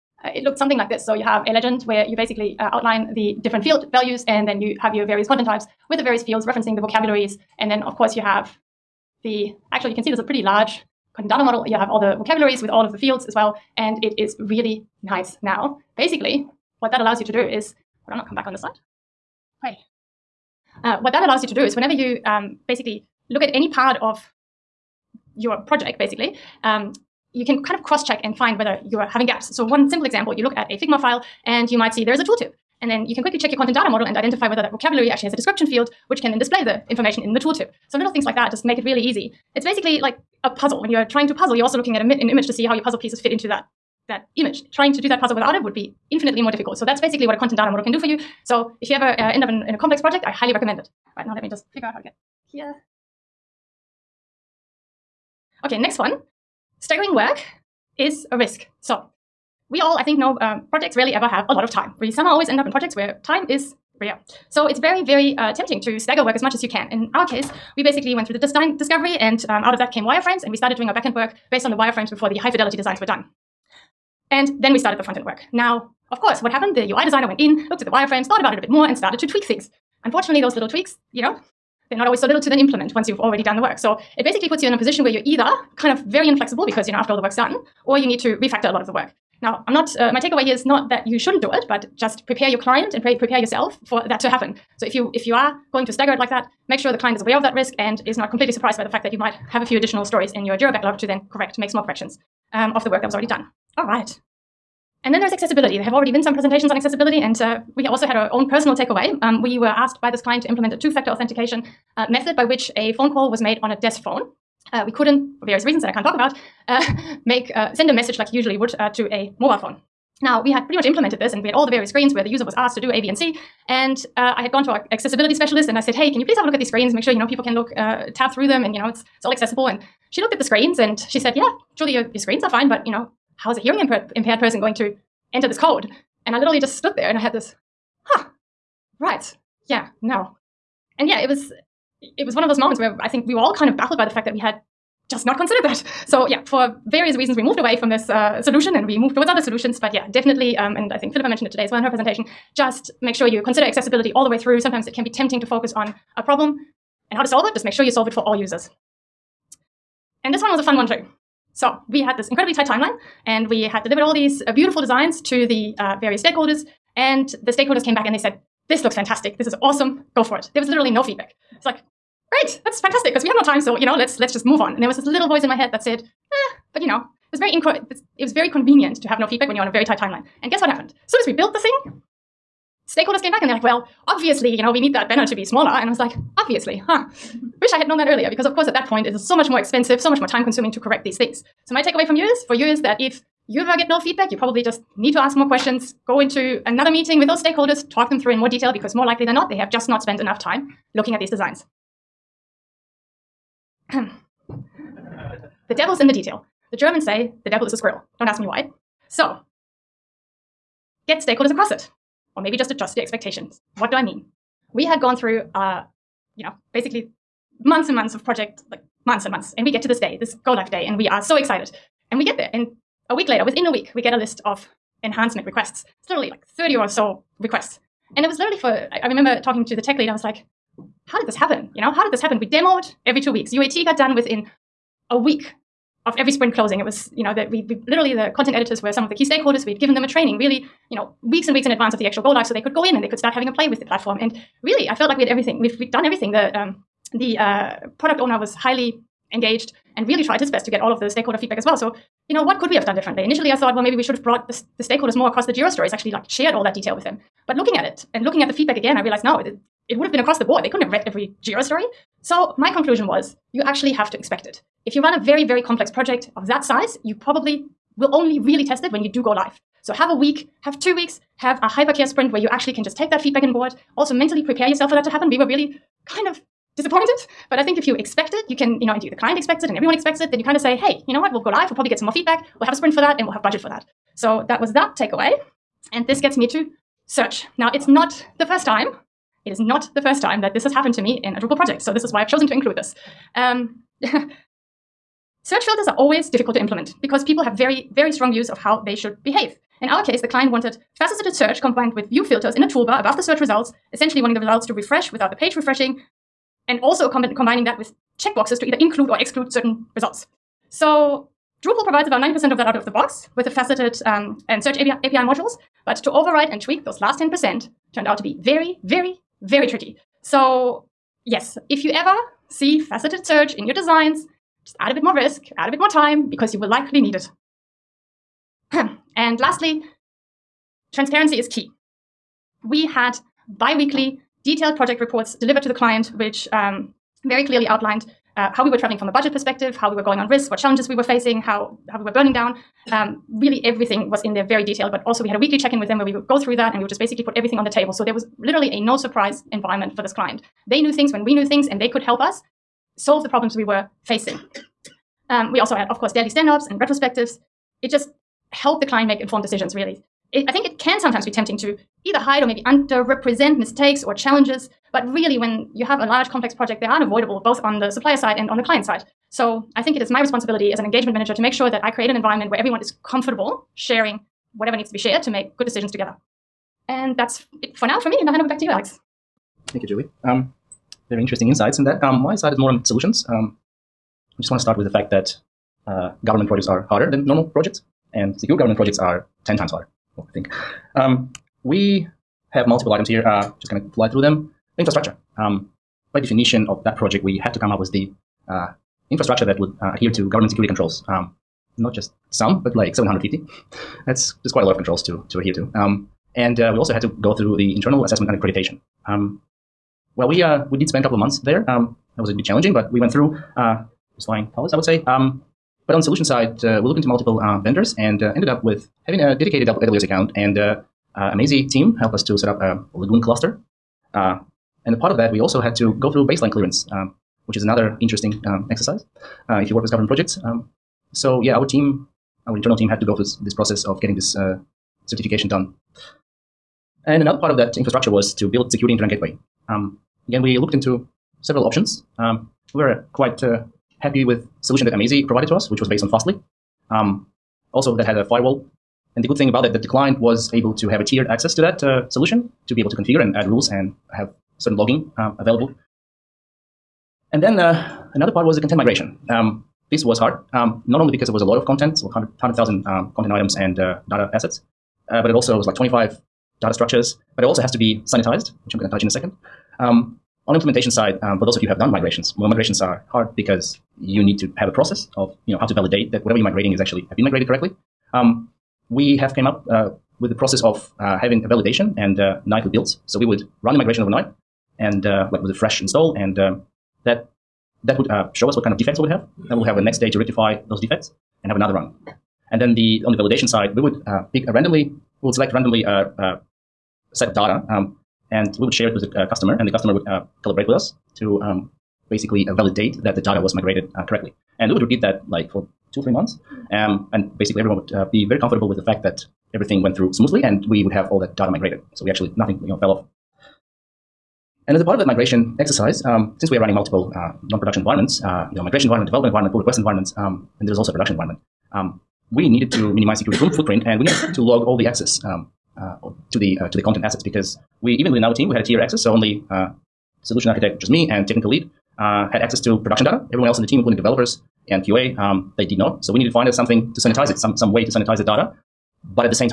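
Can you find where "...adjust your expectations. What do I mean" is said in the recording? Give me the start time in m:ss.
3:32.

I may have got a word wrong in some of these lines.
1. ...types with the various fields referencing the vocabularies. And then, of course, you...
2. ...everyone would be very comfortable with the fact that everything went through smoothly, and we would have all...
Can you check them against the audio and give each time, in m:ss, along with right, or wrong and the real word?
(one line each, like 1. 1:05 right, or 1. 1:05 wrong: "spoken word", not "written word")
1. 0:05 right
2. 8:27 right.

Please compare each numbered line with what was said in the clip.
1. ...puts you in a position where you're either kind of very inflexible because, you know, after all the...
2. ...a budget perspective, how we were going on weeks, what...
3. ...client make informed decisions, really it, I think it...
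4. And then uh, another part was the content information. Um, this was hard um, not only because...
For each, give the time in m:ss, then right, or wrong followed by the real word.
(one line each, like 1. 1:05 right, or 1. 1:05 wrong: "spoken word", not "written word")
1. 1:24 right
2. 5:39 wrong: "risks", not "weeks"
3. 5:58 right
4. 7:37 wrong: "migration", not "information".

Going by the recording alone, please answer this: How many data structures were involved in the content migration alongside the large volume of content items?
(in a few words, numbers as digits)
25.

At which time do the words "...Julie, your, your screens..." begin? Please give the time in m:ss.
2:11.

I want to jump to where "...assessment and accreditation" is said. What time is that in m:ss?
6:48.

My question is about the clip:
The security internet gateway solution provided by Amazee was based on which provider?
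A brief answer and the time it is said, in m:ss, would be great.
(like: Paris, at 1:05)
Fastly, at 7:26.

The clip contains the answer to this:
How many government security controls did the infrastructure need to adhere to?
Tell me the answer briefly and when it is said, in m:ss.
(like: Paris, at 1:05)
750, at 6:42.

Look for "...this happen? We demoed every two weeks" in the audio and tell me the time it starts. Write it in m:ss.
3:52.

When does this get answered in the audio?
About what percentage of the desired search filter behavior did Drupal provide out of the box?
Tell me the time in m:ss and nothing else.
5:12.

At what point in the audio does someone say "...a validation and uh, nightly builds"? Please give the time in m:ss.
8:01.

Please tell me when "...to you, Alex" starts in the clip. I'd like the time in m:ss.
6:18.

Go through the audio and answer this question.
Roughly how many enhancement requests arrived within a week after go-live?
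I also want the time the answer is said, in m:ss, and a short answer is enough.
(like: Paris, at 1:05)
30, at 3:46.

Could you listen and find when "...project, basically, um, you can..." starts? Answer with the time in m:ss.
0:25.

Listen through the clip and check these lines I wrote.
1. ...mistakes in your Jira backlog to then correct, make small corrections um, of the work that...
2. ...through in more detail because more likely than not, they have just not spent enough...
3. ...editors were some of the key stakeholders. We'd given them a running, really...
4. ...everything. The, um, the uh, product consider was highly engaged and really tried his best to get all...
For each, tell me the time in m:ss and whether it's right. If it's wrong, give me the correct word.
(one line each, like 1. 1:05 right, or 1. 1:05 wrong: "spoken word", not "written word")
1. 1:40 wrong: "stories", not "mistakes"
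2. 3:18 right
3. 3:58 wrong: "training", not "running"
4. 4:06 wrong: "owner", not "consider".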